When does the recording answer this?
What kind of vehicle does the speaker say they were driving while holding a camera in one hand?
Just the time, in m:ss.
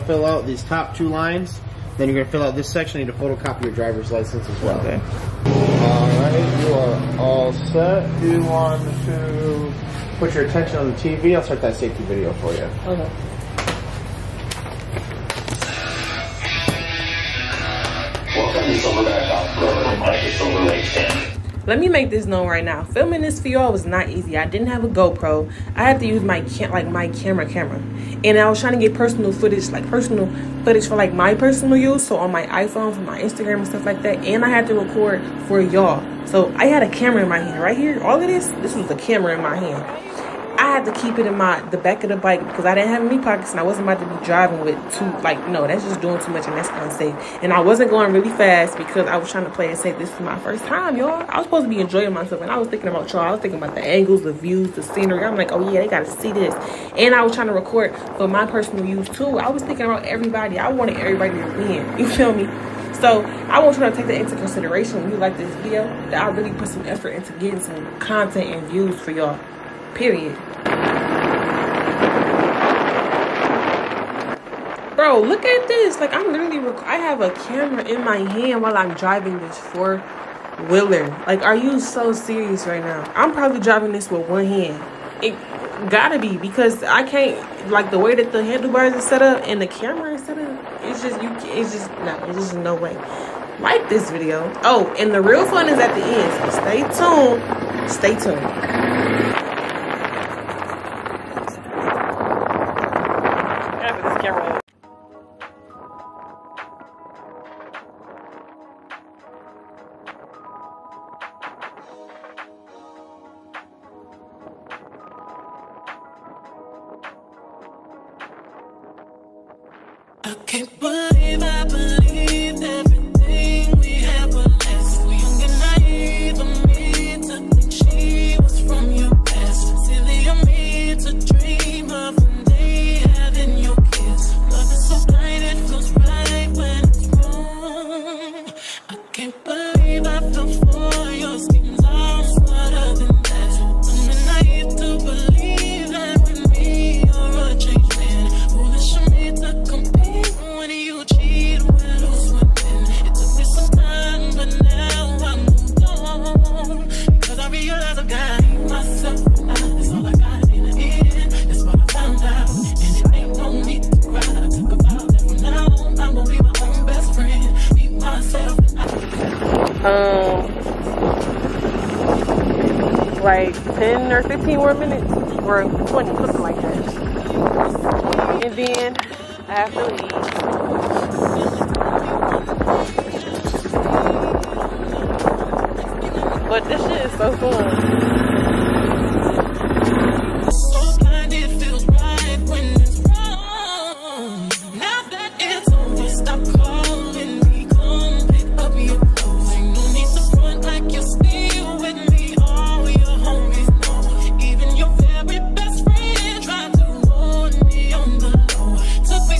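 1:19.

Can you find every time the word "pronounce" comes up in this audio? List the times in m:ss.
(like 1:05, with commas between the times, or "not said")
not said.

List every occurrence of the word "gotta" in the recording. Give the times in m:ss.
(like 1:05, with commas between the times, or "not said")
0:55, 1:25.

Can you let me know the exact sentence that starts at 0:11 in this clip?
I'll start that safety video for you.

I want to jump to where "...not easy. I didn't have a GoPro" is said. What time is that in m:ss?
0:23.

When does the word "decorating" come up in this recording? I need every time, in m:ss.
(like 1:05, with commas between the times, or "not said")
not said.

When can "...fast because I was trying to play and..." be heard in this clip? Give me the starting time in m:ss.
0:48.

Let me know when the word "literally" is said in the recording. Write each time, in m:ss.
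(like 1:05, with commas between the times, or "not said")
1:16.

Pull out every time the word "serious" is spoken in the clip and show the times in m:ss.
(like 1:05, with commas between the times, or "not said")
1:22.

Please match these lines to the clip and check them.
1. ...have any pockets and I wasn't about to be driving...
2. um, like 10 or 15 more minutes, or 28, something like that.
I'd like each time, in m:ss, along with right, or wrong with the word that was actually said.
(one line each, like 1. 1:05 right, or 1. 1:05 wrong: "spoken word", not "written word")
1. 0:42 right
2. 2:49 wrong: "20", not "28".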